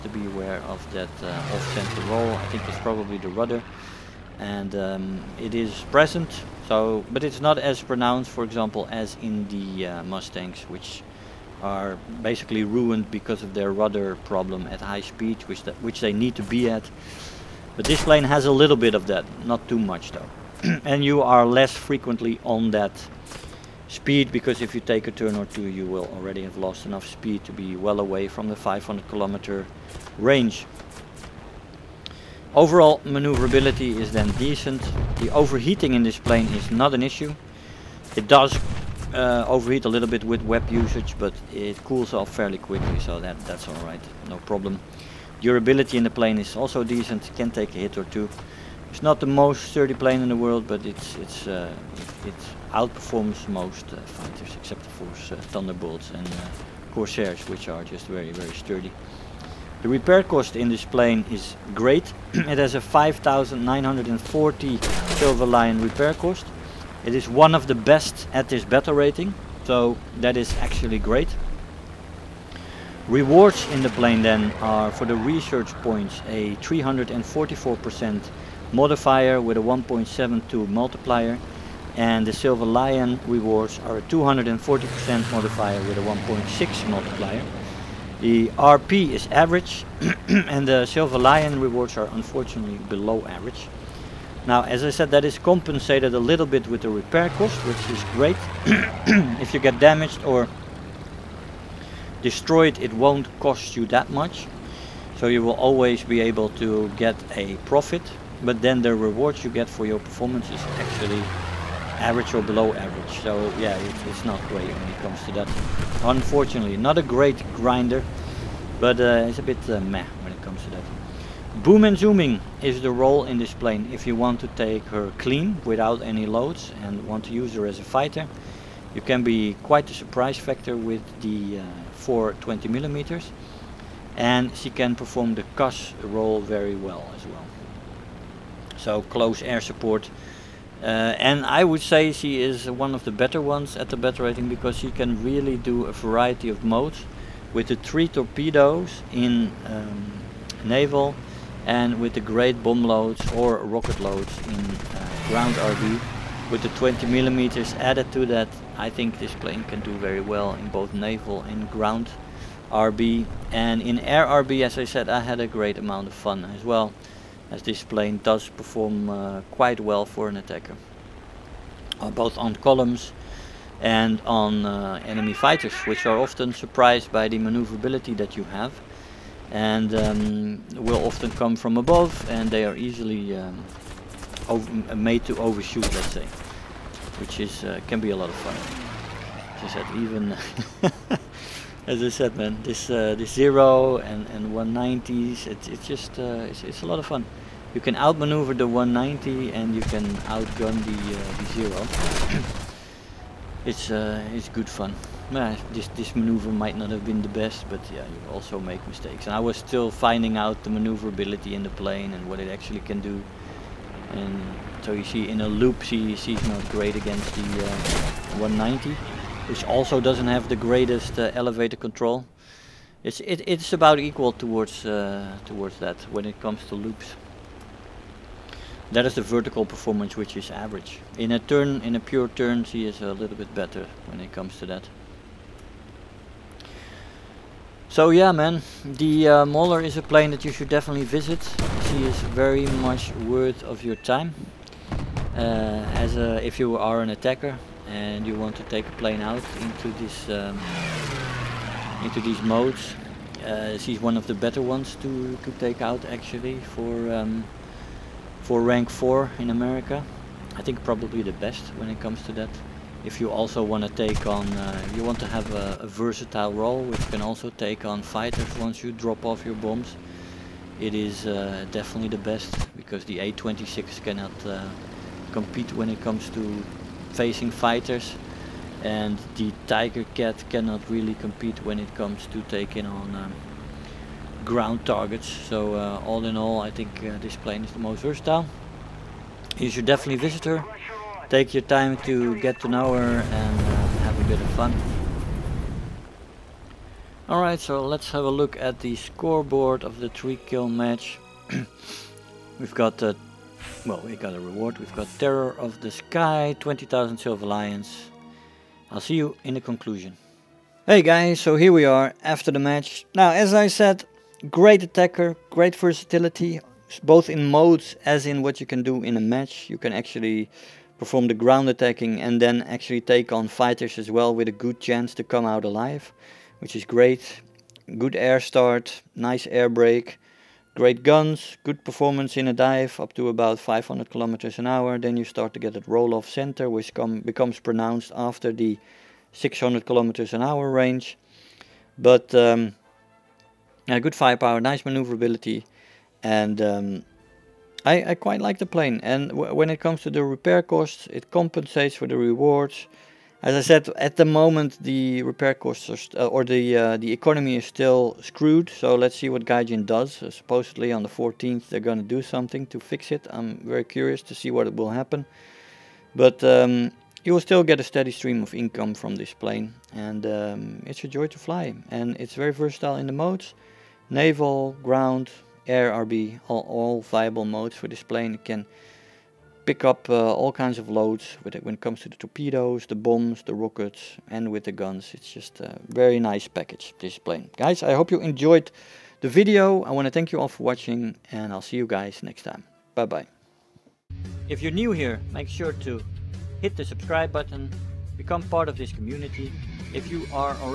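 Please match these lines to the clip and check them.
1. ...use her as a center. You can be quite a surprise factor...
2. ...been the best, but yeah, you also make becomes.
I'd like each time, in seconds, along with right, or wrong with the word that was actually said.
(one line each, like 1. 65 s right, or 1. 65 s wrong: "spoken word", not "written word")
1. 127 s wrong: "fighter", not "center"
2. 207 s wrong: "mistakes", not "becomes".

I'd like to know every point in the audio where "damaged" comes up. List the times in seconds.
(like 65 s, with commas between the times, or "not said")
99 s.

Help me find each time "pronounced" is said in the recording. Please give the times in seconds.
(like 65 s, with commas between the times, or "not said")
7 s, 337 s.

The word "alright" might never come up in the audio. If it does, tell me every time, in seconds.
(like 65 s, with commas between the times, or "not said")
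43 s, 297 s.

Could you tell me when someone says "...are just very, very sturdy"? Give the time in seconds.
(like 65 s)
57 s.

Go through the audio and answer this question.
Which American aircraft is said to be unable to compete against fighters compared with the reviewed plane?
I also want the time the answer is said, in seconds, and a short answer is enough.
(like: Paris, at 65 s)
A26, at 273 s.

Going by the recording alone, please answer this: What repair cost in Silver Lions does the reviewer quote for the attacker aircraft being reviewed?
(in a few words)
5,940.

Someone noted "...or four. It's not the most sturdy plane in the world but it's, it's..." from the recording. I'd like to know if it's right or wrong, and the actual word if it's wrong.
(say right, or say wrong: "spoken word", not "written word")
wrong: "two", not "four".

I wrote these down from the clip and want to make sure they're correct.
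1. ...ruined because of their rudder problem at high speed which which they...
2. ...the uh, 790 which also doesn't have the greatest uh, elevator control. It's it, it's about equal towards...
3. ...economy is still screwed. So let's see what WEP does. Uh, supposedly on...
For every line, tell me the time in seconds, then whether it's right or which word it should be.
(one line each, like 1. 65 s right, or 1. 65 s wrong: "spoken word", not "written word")
1. 12 s right
2. 217 s wrong: "190", not "790"
3. 357 s wrong: "Gaijin", not "WEP".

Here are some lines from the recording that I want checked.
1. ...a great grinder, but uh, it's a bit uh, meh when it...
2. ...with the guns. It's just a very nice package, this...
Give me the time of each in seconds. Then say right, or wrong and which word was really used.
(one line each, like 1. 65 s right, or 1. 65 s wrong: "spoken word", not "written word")
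1. 116 s right
2. 384 s right.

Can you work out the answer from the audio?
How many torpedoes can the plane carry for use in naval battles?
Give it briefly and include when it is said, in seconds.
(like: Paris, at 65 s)
3, at 147 s.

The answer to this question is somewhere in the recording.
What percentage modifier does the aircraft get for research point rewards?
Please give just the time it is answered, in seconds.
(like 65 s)
76 s.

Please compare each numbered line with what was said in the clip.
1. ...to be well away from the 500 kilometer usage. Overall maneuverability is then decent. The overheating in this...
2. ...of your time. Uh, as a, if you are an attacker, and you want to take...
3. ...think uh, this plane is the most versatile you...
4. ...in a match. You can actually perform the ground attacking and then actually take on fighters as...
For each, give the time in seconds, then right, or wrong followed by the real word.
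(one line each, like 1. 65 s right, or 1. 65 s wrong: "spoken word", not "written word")
1. 27 s wrong: "range", not "usage"
2. 243 s right
3. 286 s right
4. 319 s right.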